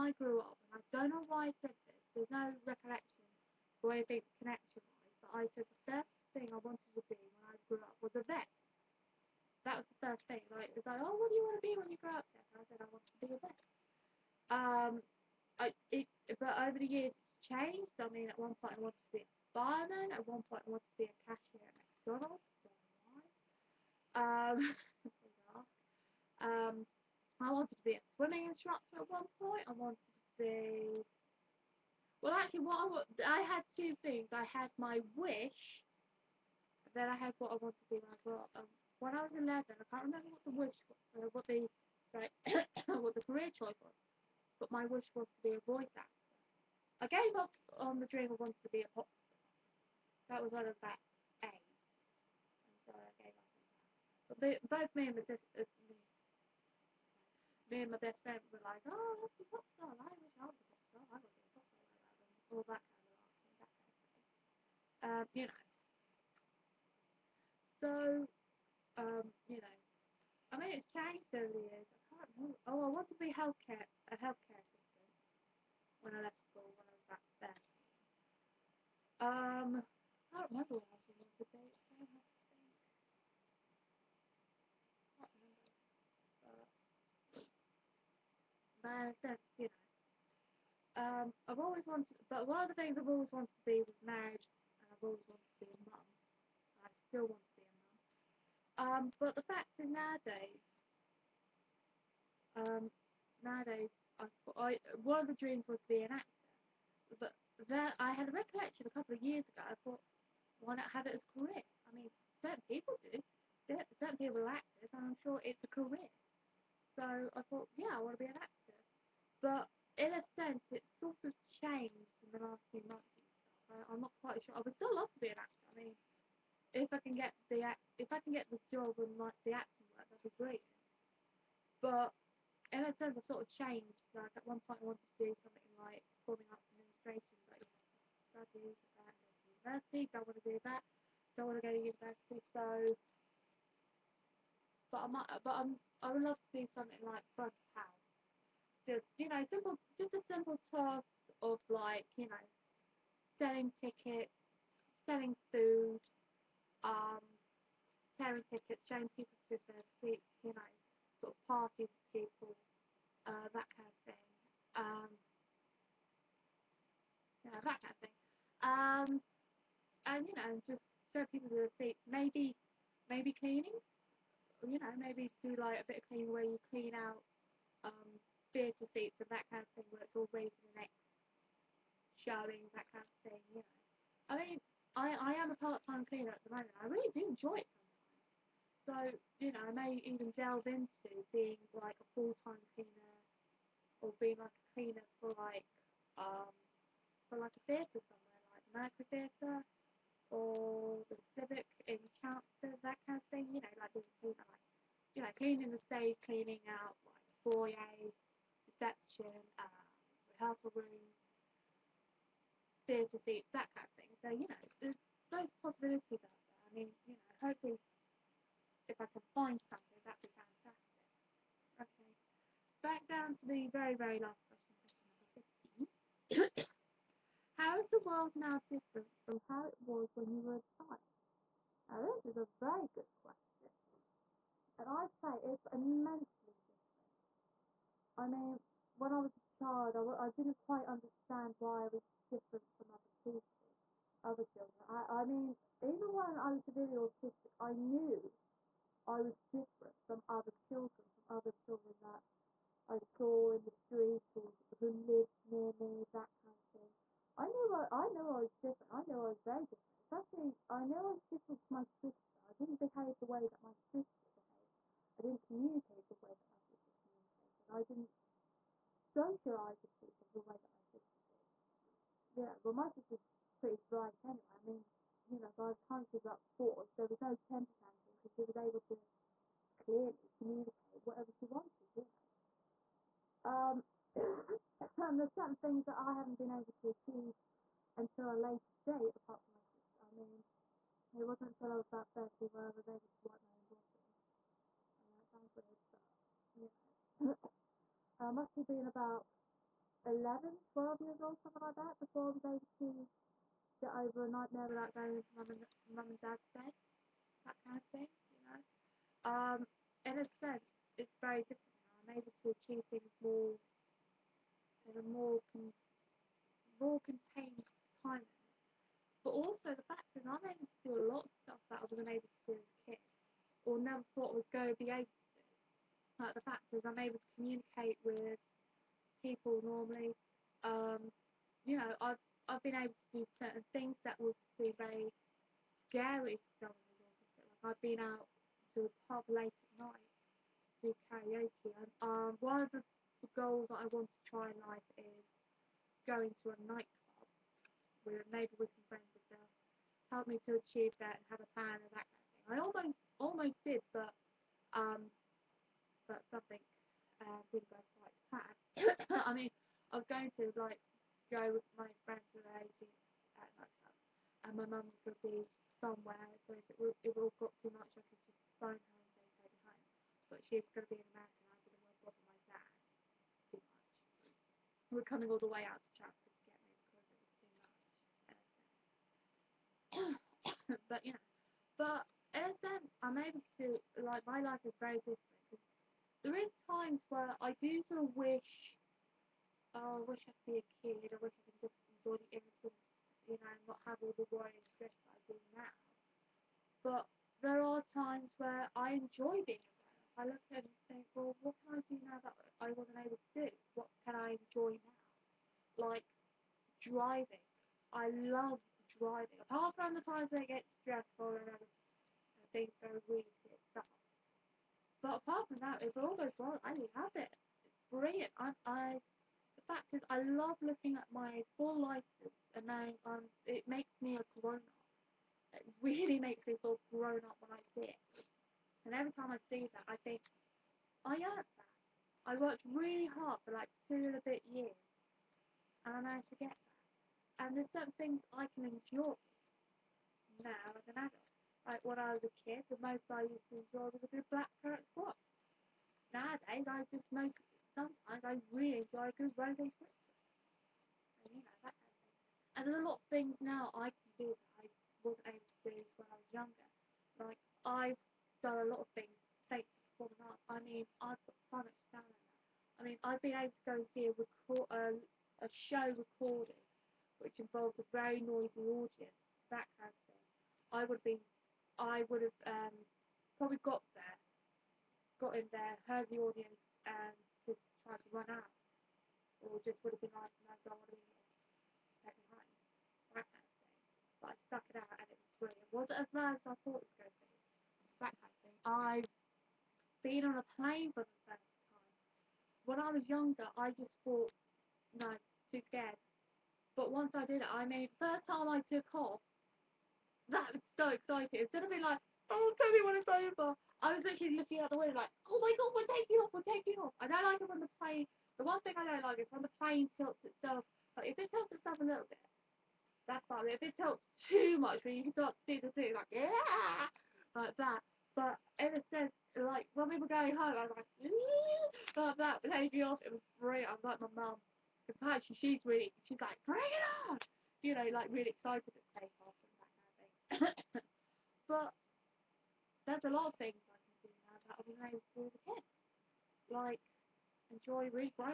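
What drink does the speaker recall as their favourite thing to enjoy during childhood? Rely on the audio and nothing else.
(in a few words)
Black carrot squash.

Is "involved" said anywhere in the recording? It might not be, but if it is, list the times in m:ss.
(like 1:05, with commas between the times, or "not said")
7:47.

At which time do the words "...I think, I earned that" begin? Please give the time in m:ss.
7:09.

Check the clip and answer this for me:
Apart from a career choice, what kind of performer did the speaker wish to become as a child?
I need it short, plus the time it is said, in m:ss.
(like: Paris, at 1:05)
Voice actor, at 0:45.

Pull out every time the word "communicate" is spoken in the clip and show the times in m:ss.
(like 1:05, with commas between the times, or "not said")
4:25, 4:40, 5:27.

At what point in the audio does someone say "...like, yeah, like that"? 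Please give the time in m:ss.
8:35.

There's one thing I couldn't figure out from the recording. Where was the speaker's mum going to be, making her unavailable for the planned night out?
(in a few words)
America.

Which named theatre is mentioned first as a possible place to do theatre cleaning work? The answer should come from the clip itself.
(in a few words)
Mercury Theatre.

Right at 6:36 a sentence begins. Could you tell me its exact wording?
But there are times where I enjoy being alone.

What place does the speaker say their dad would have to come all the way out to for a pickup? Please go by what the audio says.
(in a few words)
Chatsworth.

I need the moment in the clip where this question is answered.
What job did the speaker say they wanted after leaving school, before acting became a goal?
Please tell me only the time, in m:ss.
1:13.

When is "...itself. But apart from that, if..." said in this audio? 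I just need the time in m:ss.
6:53.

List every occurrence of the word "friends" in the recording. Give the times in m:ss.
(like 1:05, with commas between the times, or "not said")
0:58, 5:48, 6:02.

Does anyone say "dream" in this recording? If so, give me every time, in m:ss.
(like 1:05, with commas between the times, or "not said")
0:48, 1:45.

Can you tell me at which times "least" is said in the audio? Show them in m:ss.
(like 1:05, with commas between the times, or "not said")
not said.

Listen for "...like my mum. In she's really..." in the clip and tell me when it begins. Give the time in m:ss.
8:43.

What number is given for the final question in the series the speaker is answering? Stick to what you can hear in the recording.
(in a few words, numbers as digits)
15.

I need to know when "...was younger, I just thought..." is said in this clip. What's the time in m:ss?
8:12.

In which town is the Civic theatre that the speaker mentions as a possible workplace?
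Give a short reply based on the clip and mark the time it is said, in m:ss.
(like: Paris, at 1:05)
Chelmsford, at 3:22.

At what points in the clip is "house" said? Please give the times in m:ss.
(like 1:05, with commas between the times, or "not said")
2:27.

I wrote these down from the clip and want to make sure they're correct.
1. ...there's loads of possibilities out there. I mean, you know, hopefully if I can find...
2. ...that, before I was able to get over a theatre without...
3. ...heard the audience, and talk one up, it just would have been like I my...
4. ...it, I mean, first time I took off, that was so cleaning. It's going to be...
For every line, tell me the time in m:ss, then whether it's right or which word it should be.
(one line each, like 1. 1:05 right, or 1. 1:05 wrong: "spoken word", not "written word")
1. 3:34 right
2. 5:01 wrong: "nightmare", not "theatre"
3. 7:55 right
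4. 8:17 wrong: "exciting", not "cleaning".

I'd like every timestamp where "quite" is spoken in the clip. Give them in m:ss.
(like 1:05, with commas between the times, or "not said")
2:04, 4:00.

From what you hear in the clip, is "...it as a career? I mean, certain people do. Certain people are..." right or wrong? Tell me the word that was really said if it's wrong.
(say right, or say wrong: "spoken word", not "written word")
right.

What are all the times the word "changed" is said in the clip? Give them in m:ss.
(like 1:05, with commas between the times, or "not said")
1:10, 2:01, 2:13.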